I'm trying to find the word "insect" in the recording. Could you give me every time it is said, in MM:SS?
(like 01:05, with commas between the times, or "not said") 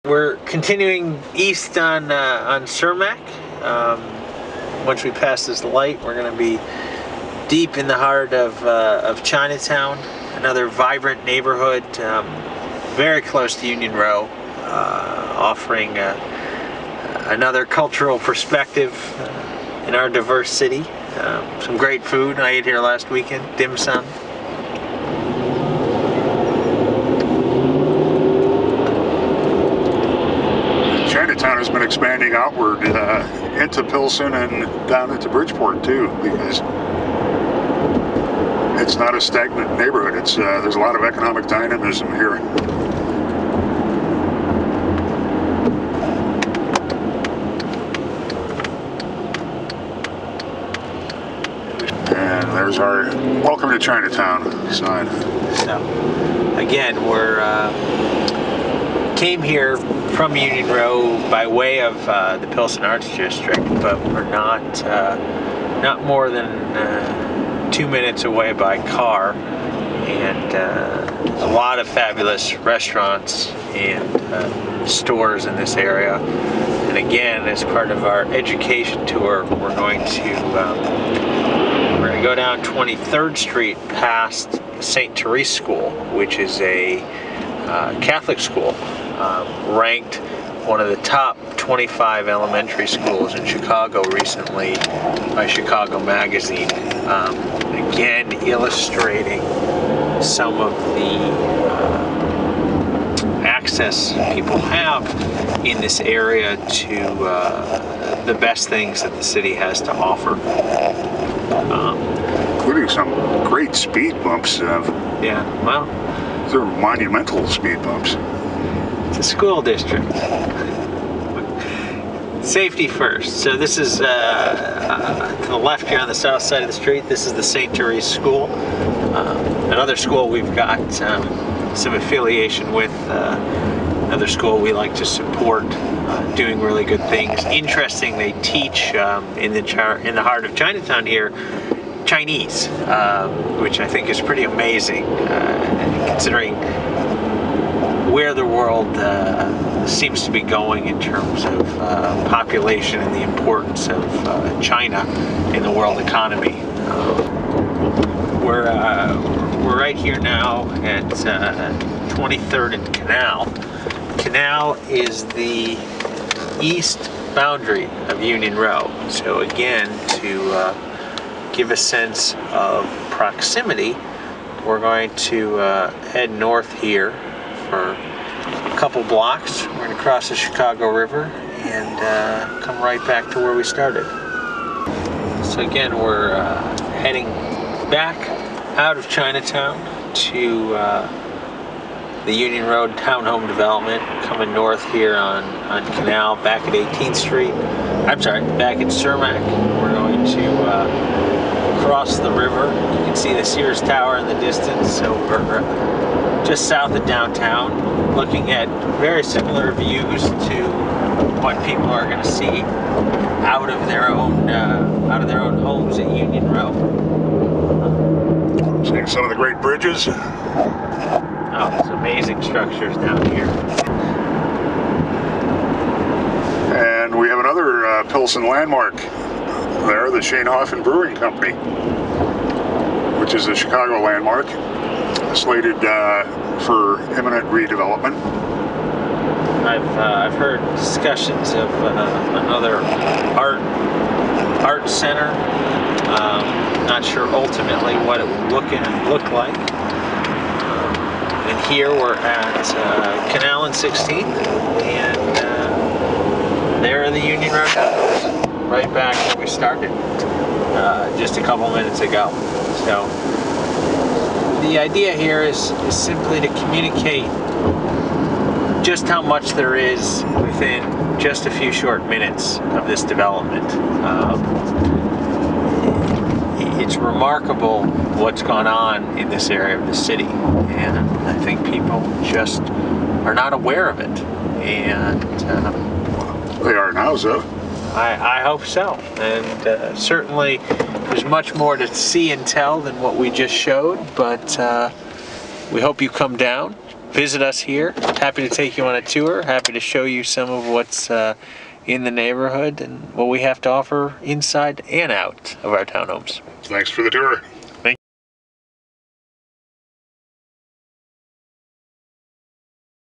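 not said.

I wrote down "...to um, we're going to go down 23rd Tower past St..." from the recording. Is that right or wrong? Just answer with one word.
wrong.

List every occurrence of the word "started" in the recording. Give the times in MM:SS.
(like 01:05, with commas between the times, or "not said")
03:03, 04:19.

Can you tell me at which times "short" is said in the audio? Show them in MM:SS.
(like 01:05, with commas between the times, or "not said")
04:31.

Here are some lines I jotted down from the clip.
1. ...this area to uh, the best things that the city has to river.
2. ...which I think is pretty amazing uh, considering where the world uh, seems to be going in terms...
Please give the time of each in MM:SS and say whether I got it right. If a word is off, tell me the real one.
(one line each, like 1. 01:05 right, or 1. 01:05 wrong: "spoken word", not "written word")
1. 01:45 wrong: "offer", not "river"
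2. 02:23 right.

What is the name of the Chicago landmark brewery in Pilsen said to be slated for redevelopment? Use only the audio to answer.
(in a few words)
Schoenhofen Brewing Company.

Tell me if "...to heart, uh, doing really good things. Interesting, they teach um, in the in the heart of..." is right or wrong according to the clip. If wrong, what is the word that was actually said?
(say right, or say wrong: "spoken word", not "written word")
wrong: "support", not "heart".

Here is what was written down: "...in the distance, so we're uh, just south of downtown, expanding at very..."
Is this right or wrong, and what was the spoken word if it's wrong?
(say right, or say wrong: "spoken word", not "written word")
wrong: "looking", not "expanding".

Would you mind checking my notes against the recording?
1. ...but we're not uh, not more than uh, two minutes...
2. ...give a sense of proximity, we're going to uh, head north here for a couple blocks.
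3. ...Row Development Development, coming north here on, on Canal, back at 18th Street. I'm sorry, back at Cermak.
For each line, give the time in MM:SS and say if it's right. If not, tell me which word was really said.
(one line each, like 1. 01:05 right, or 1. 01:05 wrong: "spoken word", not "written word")
1. 01:03 right
2. 02:51 right
3. 03:12 wrong: "Townhome", not "Development".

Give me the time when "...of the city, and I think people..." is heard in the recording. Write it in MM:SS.
04:39.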